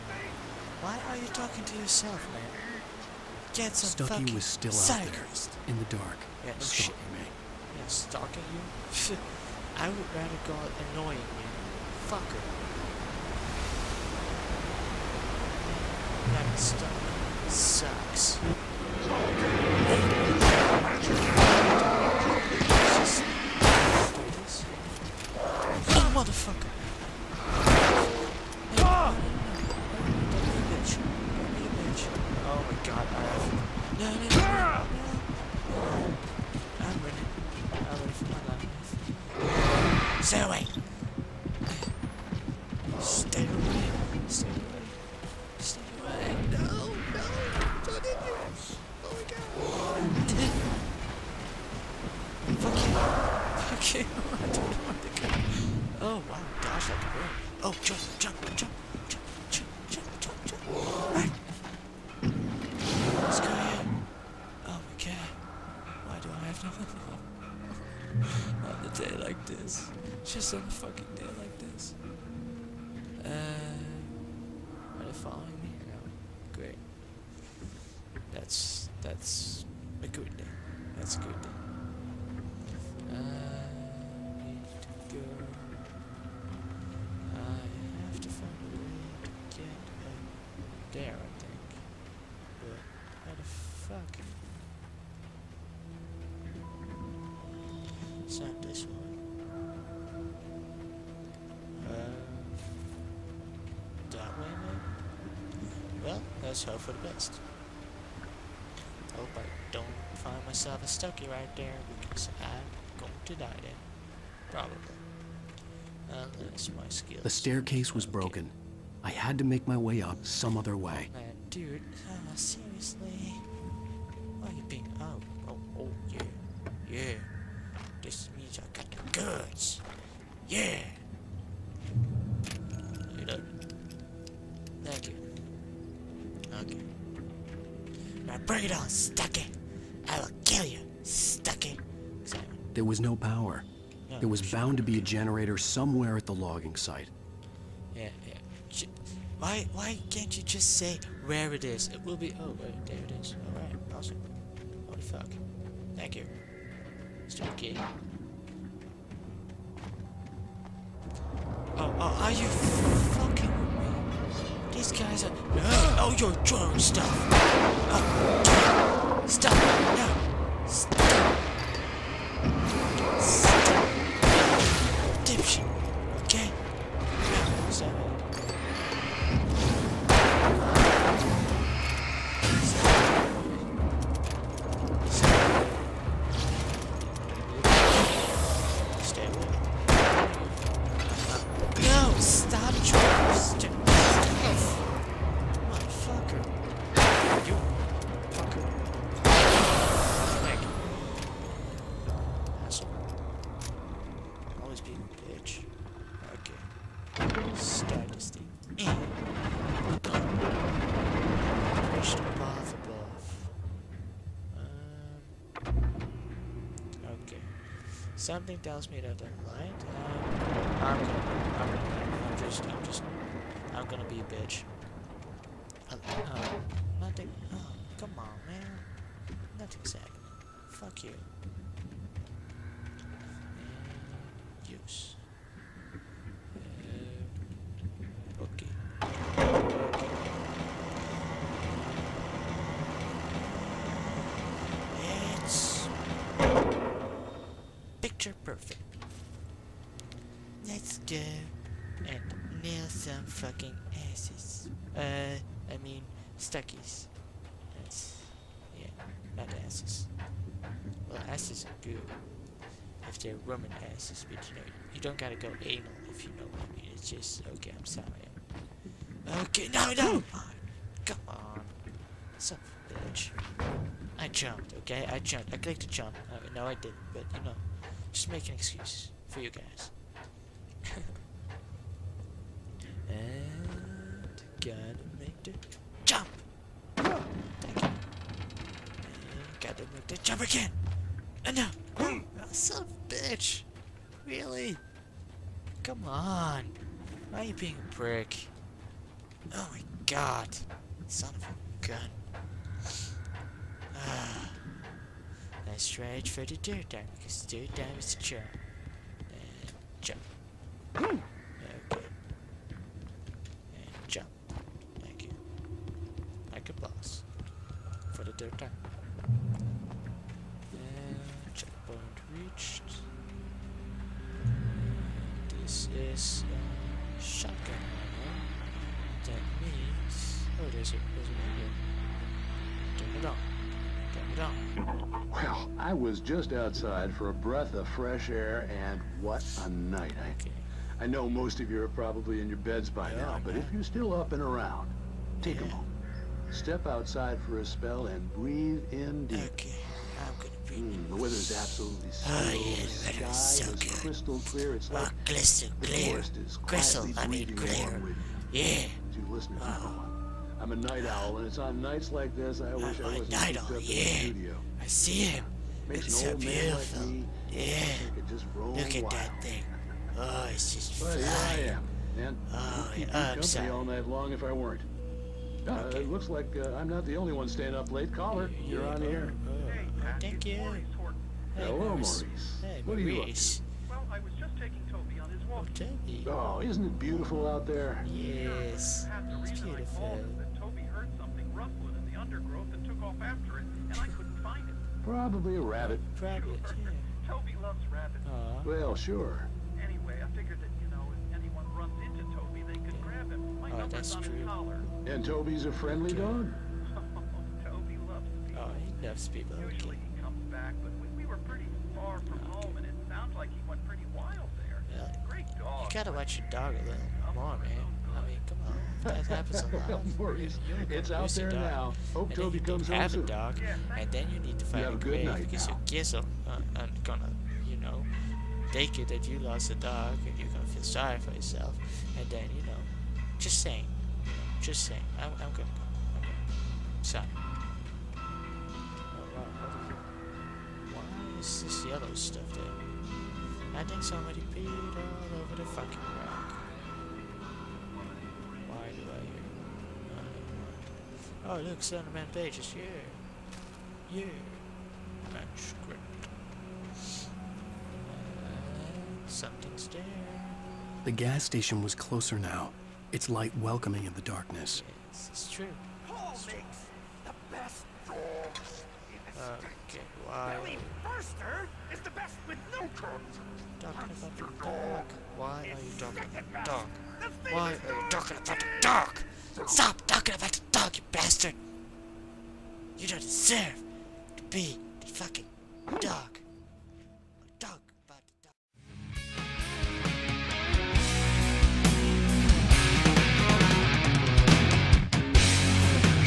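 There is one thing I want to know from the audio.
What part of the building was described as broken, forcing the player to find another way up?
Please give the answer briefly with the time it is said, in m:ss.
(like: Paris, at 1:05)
staircase, at 1:57.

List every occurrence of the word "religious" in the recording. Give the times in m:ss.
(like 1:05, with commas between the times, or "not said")
not said.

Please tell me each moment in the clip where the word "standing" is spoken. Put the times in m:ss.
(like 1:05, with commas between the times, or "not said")
not said.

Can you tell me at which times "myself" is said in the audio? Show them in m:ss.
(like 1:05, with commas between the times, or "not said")
1:50.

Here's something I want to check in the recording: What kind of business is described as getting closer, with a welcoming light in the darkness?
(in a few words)
gas station.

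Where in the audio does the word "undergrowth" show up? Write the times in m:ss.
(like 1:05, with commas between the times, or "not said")
6:32.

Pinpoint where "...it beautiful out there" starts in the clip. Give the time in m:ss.
6:26.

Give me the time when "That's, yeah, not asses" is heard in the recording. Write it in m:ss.
4:17.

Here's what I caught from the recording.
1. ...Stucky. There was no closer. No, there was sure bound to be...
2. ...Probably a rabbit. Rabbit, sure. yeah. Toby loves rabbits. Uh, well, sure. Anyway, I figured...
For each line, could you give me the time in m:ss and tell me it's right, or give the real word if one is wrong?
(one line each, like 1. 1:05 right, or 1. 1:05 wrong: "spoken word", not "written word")
1. 2:21 wrong: "power", not "closer"
2. 6:35 right.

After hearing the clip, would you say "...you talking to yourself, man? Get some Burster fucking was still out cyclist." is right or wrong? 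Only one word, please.
wrong.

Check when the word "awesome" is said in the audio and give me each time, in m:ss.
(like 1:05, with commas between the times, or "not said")
2:33.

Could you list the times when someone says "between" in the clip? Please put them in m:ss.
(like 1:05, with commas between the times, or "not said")
not said.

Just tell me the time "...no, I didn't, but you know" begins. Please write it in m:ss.
4:36.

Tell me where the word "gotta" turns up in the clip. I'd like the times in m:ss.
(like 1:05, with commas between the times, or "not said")
4:25, 4:44, 4:49, 6:55.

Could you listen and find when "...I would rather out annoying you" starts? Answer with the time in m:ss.
0:09.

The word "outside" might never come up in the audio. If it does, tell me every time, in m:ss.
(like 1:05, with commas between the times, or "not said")
5:36, 5:46.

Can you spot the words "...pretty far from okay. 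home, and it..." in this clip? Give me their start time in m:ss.
6:51.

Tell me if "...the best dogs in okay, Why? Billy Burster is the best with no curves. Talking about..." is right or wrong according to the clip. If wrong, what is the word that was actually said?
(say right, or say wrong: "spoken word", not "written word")
right.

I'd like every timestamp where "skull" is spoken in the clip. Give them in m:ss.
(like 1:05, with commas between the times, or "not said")
not said.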